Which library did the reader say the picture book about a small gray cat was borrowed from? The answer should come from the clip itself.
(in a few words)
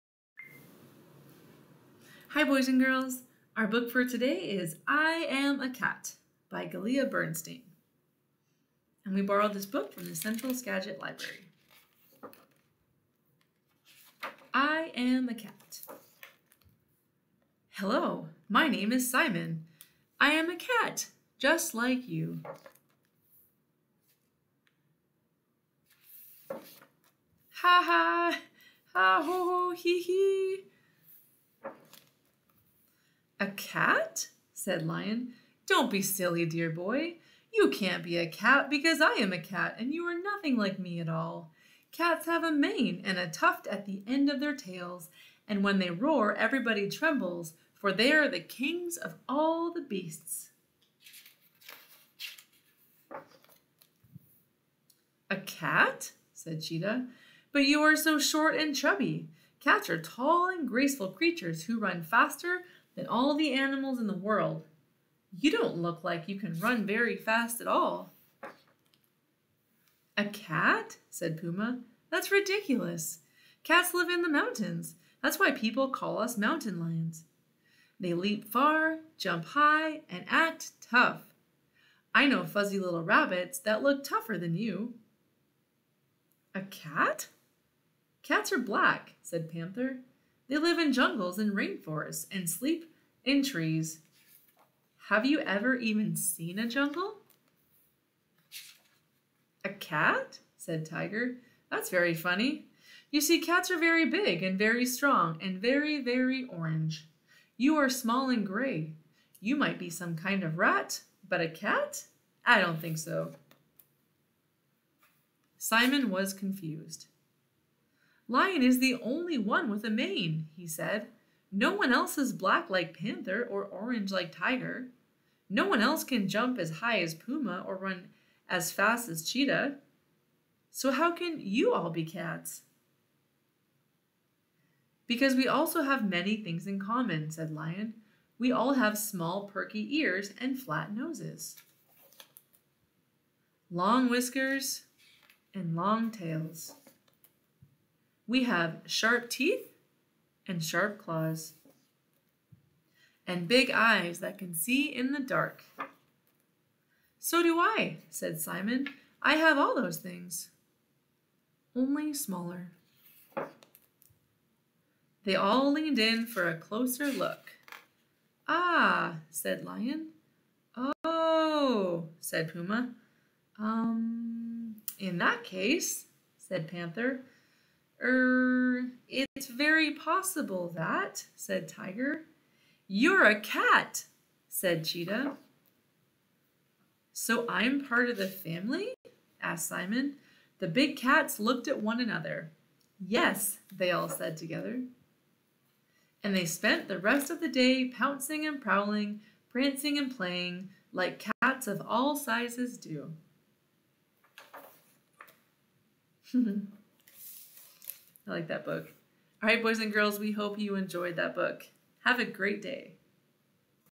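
Central Skagit Library.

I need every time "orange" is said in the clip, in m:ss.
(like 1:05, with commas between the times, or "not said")
1:46, 2:03.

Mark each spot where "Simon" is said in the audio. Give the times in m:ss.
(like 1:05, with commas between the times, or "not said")
0:19, 1:55, 2:38, 3:09.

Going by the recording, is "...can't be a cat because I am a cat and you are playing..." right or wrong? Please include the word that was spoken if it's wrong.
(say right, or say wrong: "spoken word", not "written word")
wrong: "nothing", not "playing".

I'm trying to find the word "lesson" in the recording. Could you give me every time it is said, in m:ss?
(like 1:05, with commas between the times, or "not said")
not said.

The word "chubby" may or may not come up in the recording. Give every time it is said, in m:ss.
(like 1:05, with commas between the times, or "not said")
0:58.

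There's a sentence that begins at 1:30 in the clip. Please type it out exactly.
They live in jungles and rainforests and sleep in trees.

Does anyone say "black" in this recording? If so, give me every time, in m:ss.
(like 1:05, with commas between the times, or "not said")
1:28, 2:02.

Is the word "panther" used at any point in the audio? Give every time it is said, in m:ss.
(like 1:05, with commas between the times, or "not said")
1:29, 2:02, 2:56.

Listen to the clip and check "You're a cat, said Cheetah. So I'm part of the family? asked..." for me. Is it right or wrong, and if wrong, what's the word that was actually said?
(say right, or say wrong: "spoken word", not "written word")
right.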